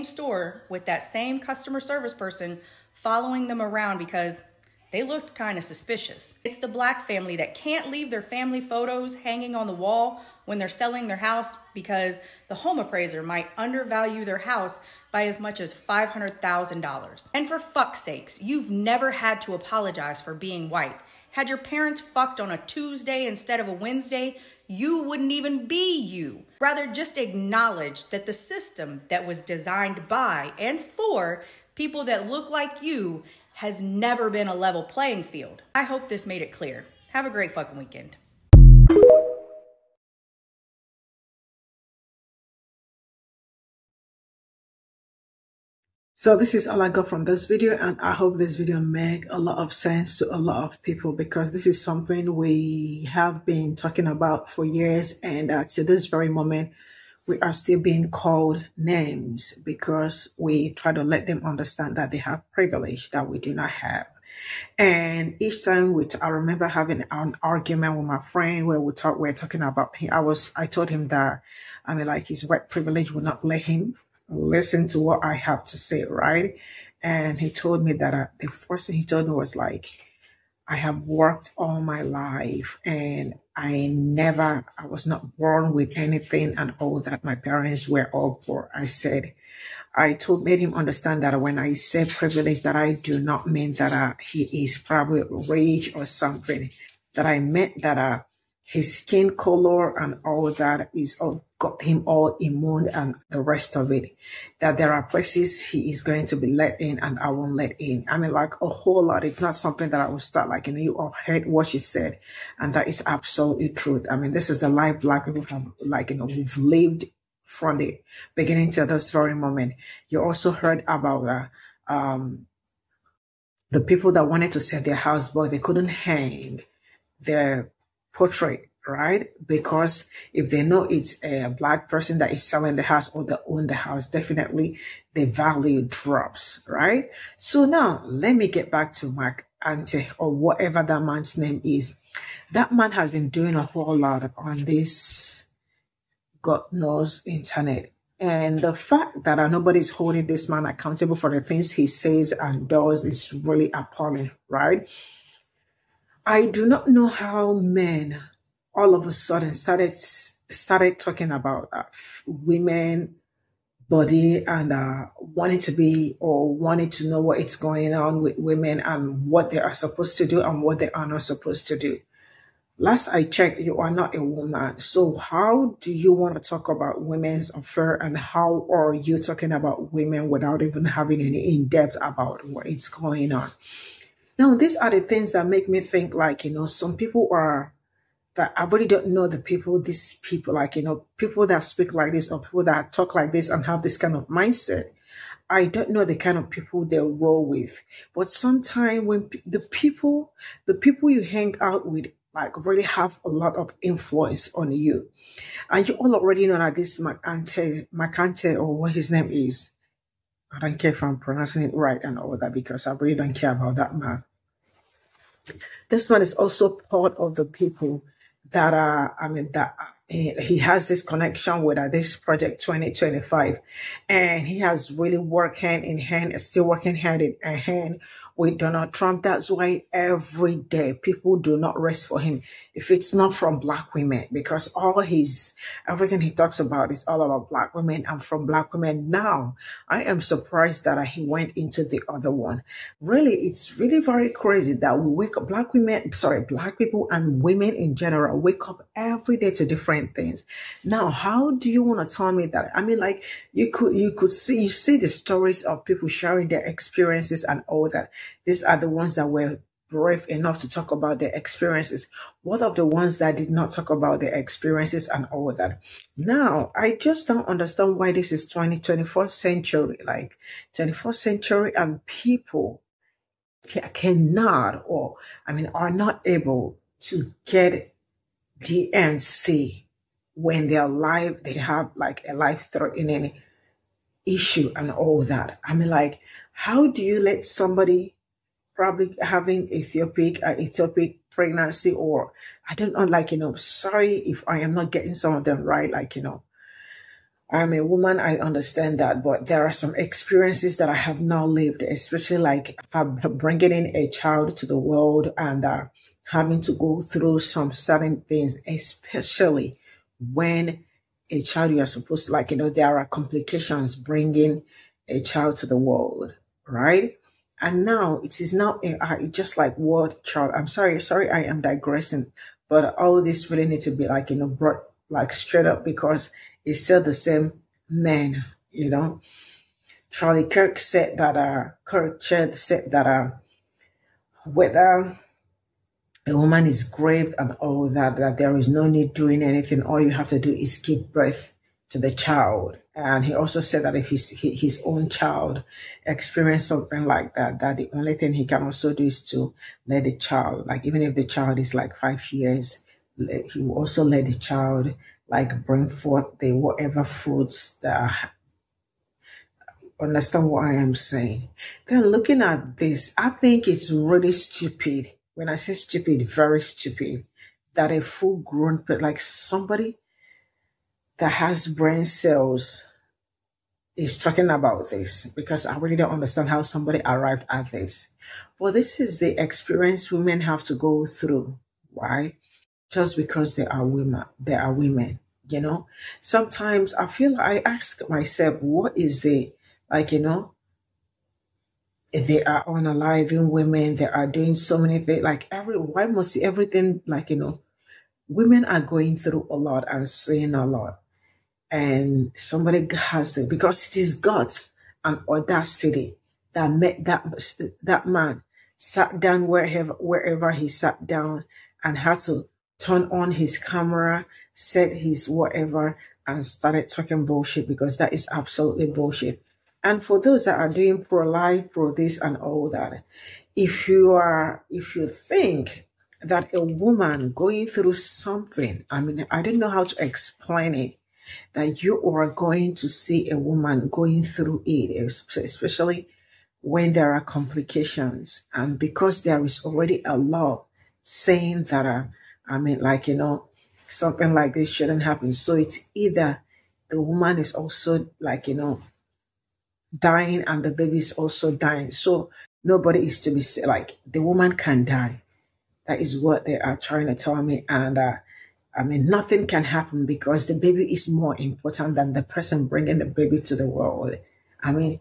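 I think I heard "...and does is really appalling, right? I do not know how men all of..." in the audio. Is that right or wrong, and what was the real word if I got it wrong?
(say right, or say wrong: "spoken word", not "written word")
right.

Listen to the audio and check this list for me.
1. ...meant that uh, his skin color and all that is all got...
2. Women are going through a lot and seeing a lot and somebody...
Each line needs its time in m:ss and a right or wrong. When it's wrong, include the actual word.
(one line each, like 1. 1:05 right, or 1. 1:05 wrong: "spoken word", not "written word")
1. 1:37 right
2. 6:38 right.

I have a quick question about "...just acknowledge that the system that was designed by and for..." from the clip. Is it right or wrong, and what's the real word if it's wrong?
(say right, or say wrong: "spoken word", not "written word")
right.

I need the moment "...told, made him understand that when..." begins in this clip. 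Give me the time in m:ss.
1:30.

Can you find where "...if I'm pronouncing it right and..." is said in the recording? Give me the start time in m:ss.
3:30.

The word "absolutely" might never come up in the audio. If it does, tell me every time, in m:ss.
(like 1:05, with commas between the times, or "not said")
1:53, 6:58.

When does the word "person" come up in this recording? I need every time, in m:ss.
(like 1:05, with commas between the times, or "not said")
0:02, 2:11, 7:42.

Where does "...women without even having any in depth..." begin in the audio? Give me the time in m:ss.
2:59.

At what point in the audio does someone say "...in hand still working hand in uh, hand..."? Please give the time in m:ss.
3:45.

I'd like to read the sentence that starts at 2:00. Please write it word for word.
You also heard about, uh, um, the people that wanted to sell their house, but they couldn't hang their portrait, right?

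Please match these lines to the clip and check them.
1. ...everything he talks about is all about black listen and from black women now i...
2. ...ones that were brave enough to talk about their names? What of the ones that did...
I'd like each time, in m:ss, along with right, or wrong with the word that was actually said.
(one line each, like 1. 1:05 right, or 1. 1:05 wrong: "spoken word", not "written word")
1. 3:55 wrong: "women", not "listen"
2. 4:18 wrong: "experiences", not "names".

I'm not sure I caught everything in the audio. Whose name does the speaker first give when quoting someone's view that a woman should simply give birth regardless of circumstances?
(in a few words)
Charlie Kirk.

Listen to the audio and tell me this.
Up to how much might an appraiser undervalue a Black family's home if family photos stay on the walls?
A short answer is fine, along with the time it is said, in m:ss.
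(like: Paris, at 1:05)
$500,000, at 0:15.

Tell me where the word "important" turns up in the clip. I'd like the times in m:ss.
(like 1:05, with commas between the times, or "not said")
7:41.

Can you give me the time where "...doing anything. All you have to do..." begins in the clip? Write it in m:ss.
5:39.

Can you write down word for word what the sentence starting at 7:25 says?
So it's either the woman is also, like, you know, dying and the baby is also dying.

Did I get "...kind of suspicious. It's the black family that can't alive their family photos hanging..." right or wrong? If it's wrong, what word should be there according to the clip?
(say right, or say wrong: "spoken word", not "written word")
wrong: "leave", not "alive".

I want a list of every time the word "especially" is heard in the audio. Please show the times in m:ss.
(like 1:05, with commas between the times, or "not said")
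5:01, 5:08, 7:15.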